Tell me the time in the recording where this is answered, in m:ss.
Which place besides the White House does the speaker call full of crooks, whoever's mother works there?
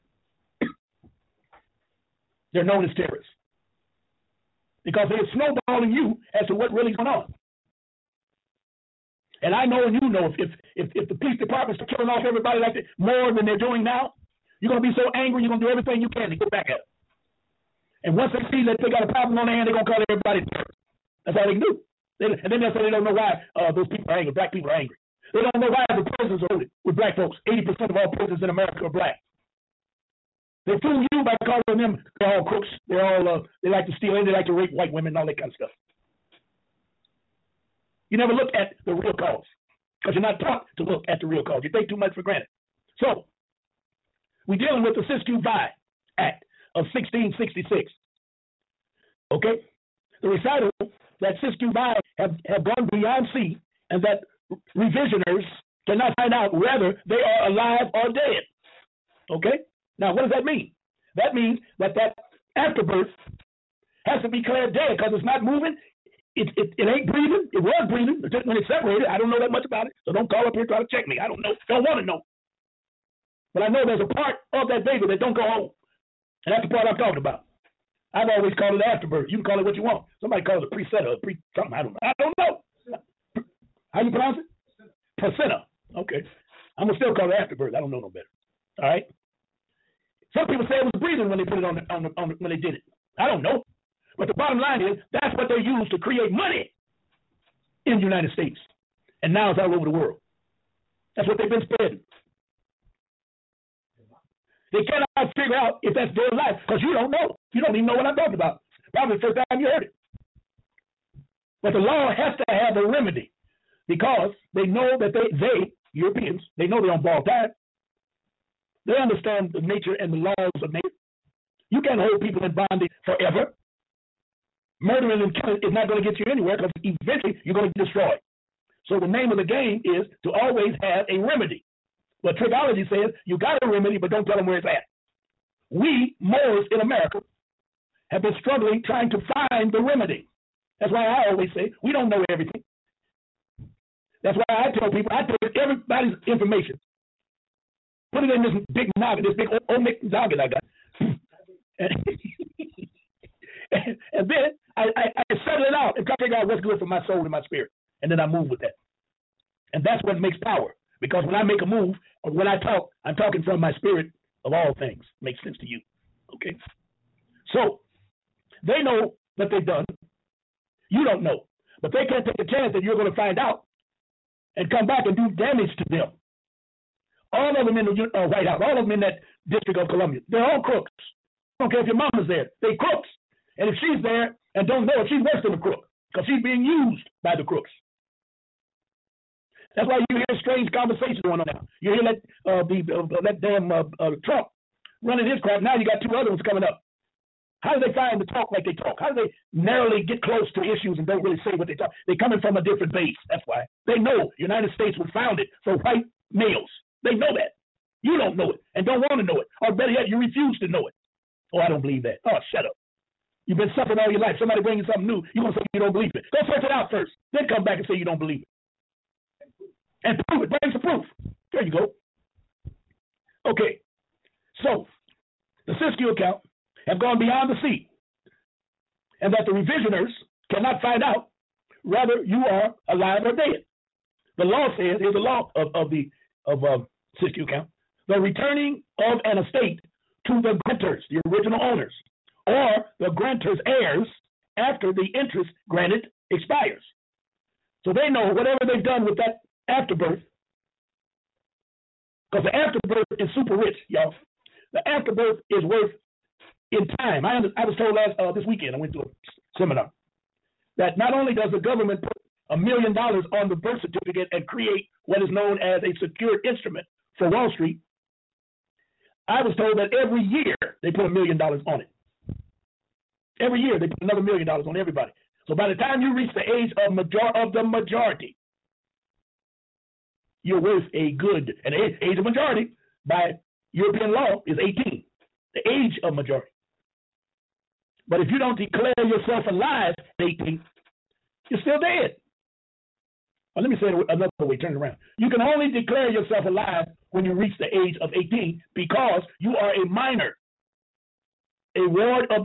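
2:59.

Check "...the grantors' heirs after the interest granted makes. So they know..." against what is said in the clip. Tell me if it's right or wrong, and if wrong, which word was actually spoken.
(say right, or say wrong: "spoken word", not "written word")
wrong: "expires", not "makes".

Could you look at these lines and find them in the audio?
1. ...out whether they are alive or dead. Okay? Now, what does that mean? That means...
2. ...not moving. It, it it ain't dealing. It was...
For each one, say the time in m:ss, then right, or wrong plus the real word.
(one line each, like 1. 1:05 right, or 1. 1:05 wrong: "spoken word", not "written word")
1. 0:56 right
2. 1:05 wrong: "breathing", not "dealing".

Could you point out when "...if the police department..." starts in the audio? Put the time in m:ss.
0:10.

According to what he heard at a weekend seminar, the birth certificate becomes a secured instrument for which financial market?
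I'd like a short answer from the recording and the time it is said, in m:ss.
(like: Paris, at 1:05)
Wall Street, at 4:27.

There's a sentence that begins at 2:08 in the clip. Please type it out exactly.
So the name of the game is to always have a remedy.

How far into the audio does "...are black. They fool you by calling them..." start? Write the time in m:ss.
0:28.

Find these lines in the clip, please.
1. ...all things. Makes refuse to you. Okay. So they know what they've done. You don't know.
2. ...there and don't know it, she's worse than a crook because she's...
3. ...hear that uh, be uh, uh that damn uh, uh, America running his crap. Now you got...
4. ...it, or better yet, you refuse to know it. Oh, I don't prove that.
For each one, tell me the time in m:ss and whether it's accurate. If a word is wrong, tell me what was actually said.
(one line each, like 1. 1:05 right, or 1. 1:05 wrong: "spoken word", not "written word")
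1. 2:44 wrong: "sense", not "refuse"
2. 3:04 right
3. 3:11 wrong: "Trump", not "America"
4. 3:29 wrong: "believe", not "prove".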